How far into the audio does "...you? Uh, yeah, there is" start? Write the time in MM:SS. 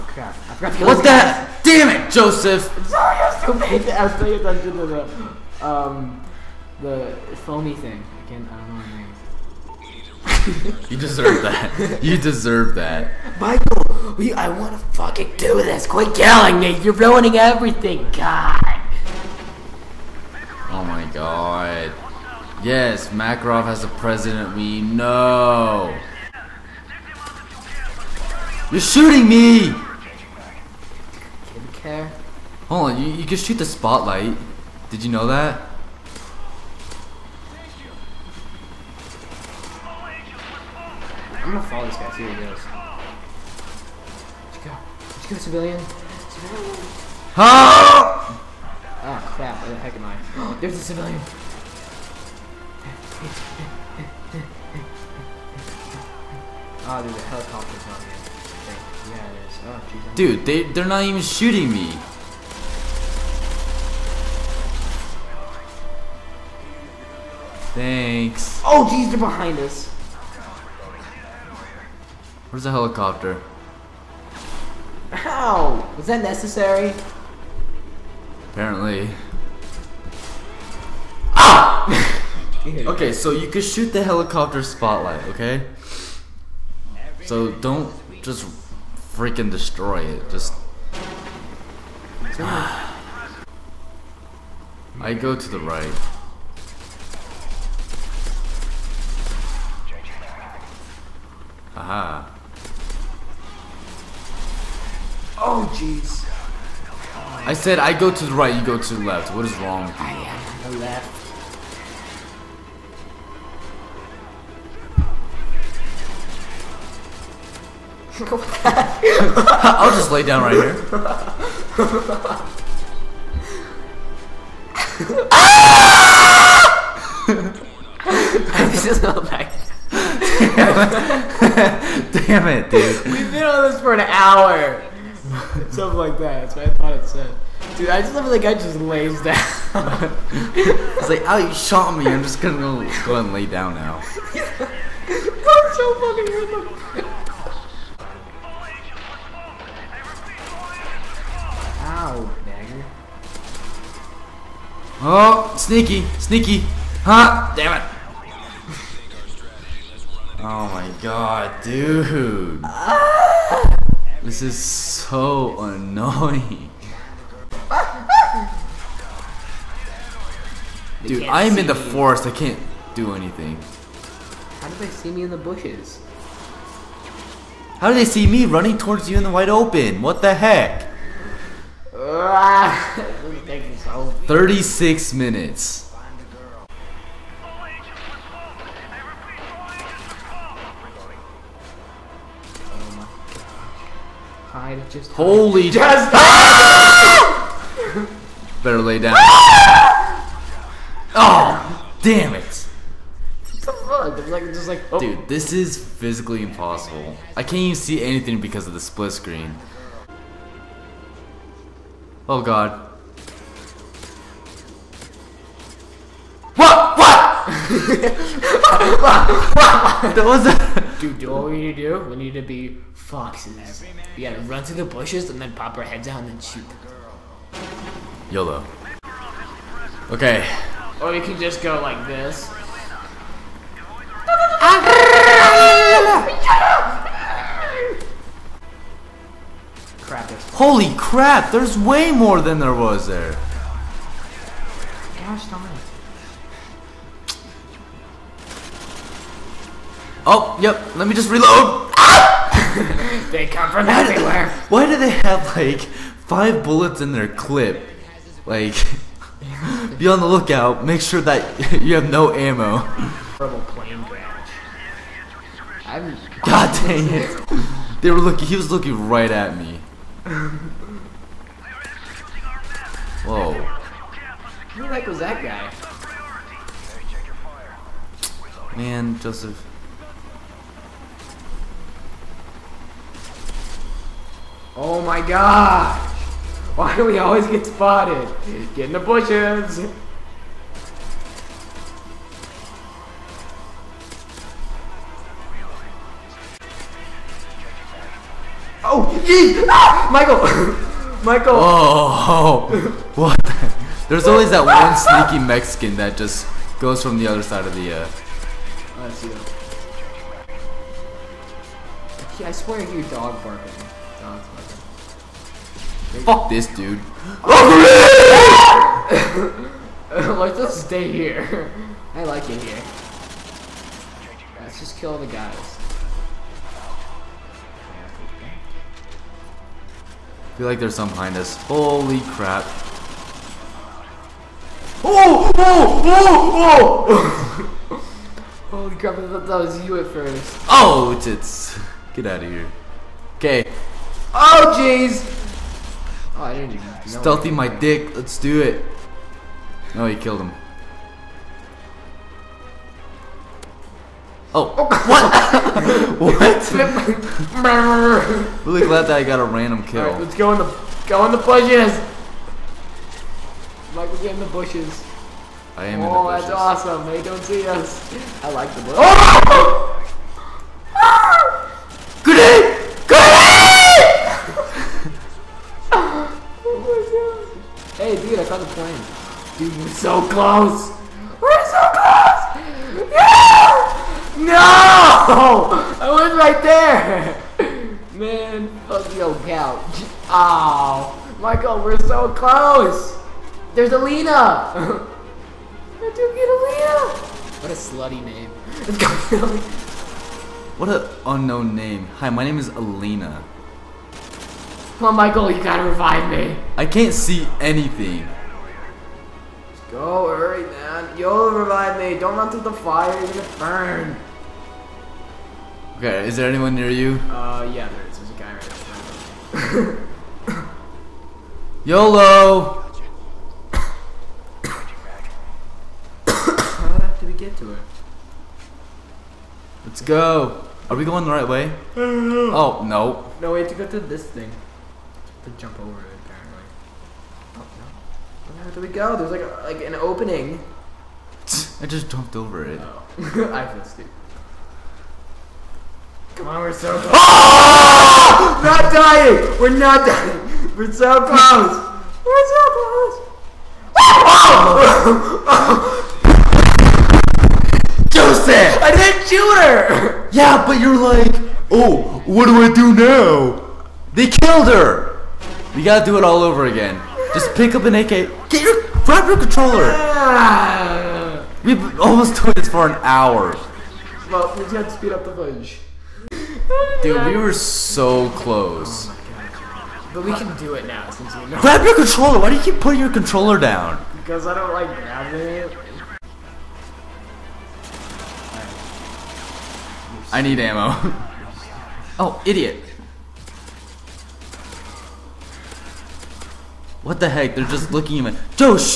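06:56.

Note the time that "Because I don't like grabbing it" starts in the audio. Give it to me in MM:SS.
08:04.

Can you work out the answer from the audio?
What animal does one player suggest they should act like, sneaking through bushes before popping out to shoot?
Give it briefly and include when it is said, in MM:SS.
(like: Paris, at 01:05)
Foxes, at 03:42.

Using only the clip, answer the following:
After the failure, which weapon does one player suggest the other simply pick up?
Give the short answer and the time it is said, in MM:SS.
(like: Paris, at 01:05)
An AK, at 07:47.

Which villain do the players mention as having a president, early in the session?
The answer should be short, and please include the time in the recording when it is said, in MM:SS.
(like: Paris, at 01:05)
Makarov, at 00:23.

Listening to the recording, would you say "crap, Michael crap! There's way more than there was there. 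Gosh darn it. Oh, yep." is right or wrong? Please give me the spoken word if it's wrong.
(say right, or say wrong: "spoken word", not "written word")
wrong: "Holy", not "Michael".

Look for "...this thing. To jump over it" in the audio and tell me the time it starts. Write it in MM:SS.
07:14.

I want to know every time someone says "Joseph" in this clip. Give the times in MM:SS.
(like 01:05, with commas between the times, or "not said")
00:02, 04:39, 07:38.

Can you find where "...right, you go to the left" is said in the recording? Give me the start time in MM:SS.
01:48.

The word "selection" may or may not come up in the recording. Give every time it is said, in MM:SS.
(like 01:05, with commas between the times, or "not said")
not said.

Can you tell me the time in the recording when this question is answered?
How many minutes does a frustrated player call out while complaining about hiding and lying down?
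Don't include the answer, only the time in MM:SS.
03:04.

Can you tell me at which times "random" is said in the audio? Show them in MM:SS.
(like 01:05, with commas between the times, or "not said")
02:26, 05:59.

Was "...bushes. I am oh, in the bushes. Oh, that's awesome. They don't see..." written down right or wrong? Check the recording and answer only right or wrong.
right.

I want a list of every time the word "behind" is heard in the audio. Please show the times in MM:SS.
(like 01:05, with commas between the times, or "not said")
01:09, 05:31.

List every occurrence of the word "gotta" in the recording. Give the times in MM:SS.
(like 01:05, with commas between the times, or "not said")
03:44, 06:45, 07:45.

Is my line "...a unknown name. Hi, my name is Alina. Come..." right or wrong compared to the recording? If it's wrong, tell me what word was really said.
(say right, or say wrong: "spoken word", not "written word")
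right.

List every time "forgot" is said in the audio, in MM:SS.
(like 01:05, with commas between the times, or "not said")
00:00.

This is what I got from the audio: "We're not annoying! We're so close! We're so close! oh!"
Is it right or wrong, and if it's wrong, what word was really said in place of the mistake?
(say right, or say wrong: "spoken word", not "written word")
wrong: "dying", not "annoying".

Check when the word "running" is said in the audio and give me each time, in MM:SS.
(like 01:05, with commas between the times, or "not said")
02:58.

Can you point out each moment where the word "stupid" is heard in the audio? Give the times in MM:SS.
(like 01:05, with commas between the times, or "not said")
00:03, 07:23.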